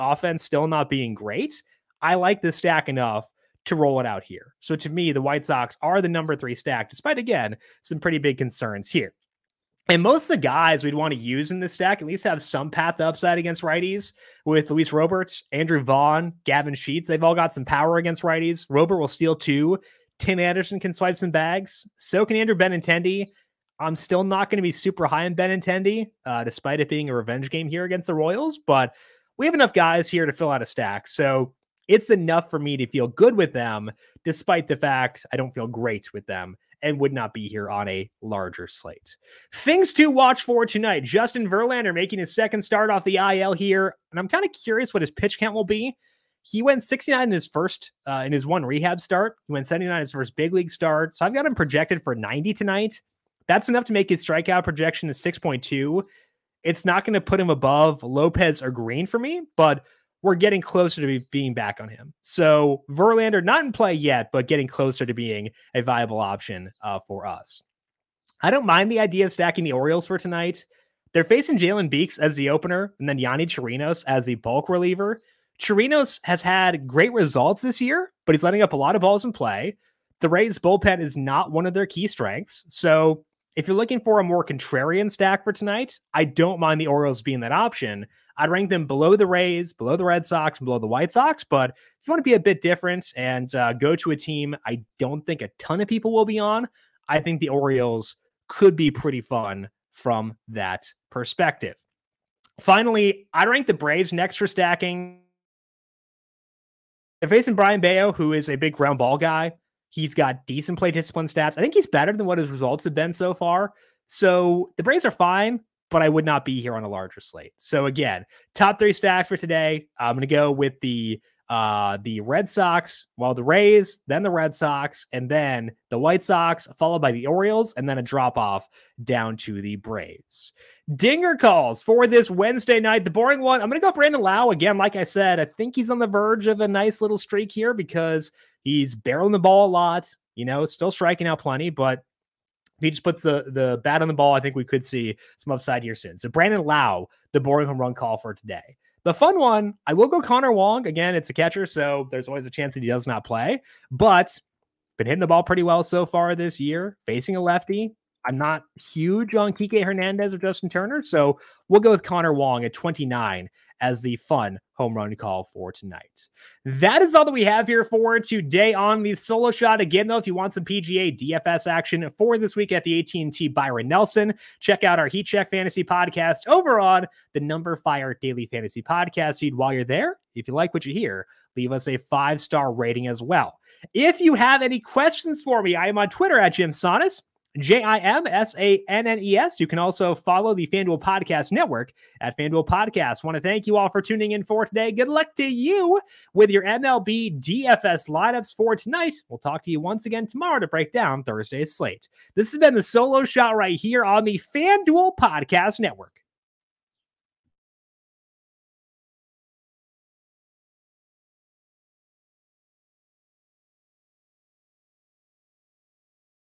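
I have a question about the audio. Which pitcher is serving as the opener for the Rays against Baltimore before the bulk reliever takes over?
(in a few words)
Jalen Beeks.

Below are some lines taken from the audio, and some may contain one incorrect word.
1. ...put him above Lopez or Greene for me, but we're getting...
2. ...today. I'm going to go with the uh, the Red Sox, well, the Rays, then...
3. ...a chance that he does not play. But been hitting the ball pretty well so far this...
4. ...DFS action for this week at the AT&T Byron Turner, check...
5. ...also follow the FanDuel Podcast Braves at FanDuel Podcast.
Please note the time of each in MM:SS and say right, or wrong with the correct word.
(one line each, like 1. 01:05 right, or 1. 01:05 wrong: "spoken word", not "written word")
1. 00:57 right
2. 01:59 right
3. 02:32 right
4. 02:51 wrong: "Nelson", not "Turner"
5. 03:09 wrong: "Network", not "Braves".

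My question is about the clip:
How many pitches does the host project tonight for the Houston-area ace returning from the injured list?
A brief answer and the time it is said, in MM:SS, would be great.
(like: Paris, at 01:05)
90, at 00:52.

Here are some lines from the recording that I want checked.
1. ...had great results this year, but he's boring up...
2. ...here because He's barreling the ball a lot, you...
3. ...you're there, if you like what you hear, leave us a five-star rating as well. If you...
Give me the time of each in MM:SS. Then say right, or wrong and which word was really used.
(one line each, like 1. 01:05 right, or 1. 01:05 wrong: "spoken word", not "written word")
1. 01:16 wrong: "letting", not "boring"
2. 02:17 right
3. 02:59 right.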